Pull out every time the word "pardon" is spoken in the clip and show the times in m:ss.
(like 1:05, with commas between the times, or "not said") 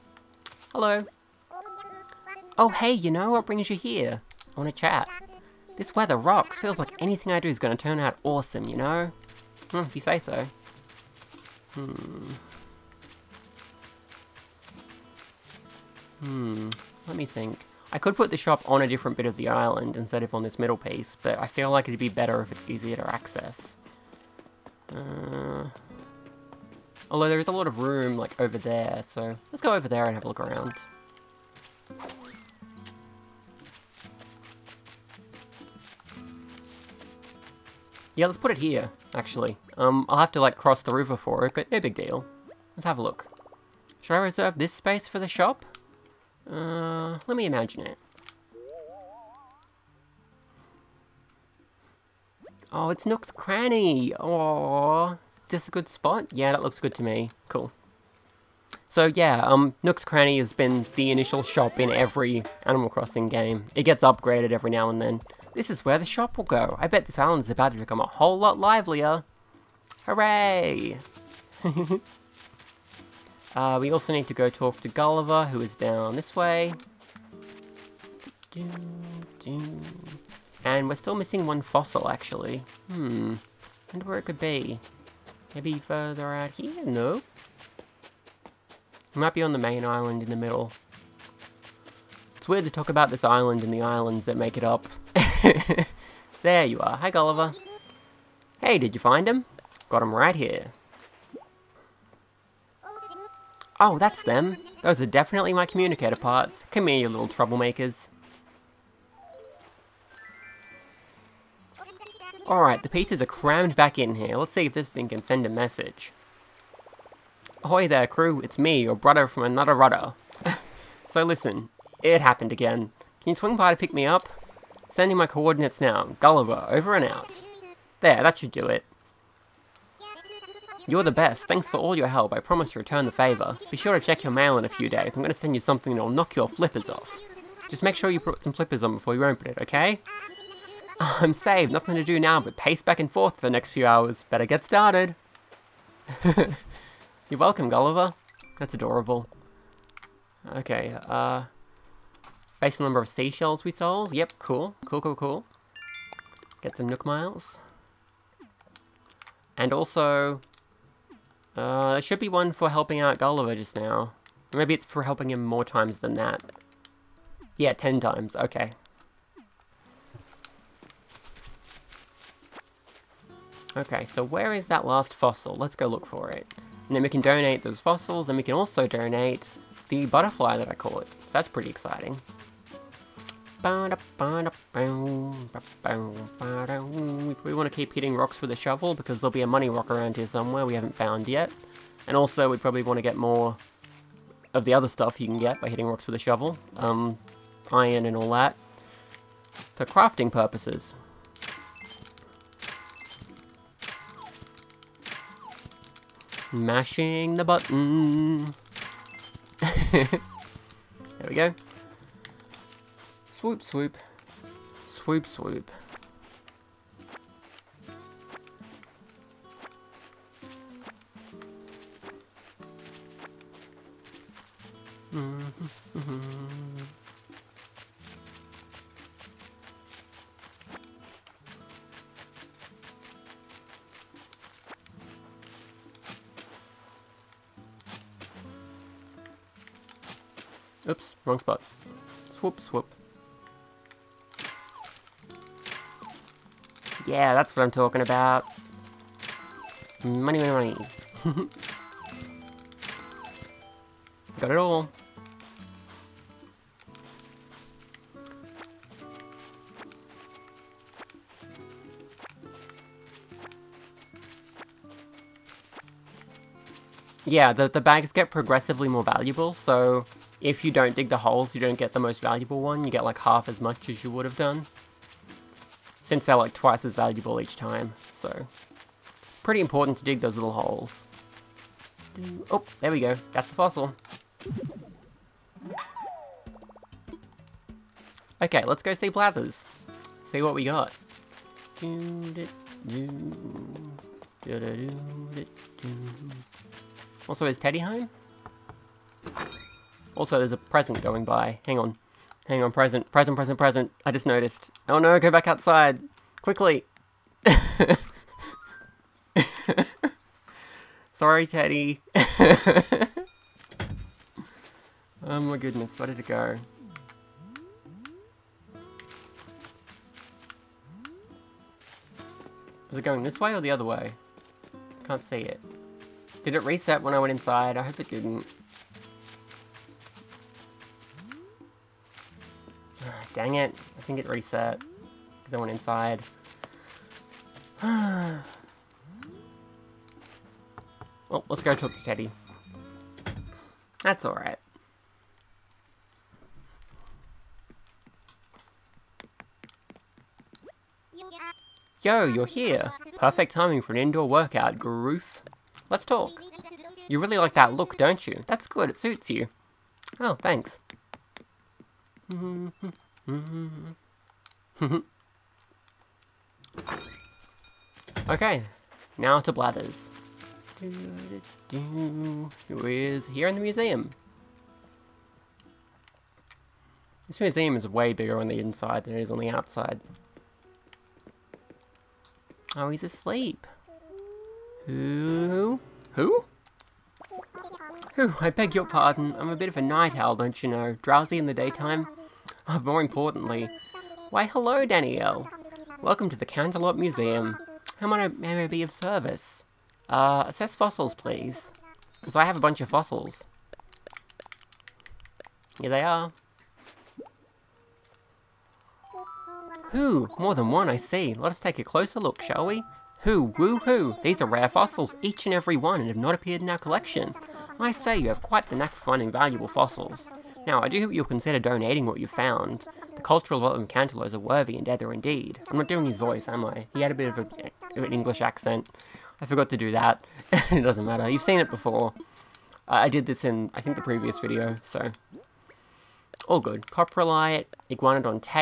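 6:28.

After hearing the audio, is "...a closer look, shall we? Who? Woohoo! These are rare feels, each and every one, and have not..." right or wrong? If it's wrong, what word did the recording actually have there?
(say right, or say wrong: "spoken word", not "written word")
wrong: "fossils", not "feels".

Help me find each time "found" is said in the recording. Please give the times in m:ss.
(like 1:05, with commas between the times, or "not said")
3:10, 7:02.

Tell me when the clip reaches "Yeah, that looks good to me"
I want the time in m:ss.
0:56.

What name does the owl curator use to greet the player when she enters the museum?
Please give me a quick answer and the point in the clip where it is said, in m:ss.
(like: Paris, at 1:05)
Danielle, at 6:34.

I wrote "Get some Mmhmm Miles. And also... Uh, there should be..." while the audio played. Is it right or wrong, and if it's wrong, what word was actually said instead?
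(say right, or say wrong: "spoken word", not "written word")
wrong: "Nook", not "Mmhmm".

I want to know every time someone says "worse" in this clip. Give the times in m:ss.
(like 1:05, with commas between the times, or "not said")
not said.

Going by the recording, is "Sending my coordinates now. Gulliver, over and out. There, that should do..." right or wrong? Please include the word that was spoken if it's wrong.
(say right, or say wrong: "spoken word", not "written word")
right.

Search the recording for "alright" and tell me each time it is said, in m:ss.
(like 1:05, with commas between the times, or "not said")
1:52, 5:44.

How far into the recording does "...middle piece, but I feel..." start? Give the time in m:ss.
0:20.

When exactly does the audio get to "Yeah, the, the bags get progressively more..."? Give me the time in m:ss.
4:27.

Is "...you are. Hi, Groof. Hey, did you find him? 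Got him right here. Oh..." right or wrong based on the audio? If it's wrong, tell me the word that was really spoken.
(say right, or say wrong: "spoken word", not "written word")
wrong: "Gulliver", not "Groof".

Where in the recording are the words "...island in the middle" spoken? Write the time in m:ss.
1:29.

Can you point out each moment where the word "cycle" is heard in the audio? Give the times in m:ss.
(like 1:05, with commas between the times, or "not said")
not said.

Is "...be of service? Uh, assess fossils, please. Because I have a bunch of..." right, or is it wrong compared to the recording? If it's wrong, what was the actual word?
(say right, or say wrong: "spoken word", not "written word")
right.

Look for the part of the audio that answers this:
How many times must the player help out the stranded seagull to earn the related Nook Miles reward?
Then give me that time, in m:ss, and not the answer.
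2:47.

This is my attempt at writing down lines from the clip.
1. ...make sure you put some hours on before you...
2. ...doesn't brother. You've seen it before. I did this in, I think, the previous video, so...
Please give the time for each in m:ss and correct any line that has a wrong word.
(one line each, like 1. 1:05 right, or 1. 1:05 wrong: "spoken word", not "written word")
1. 2:17 wrong: "flippers", not "hours"
2. 7:10 wrong: "matter", not "brother".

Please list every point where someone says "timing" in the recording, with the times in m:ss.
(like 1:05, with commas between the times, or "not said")
5:53.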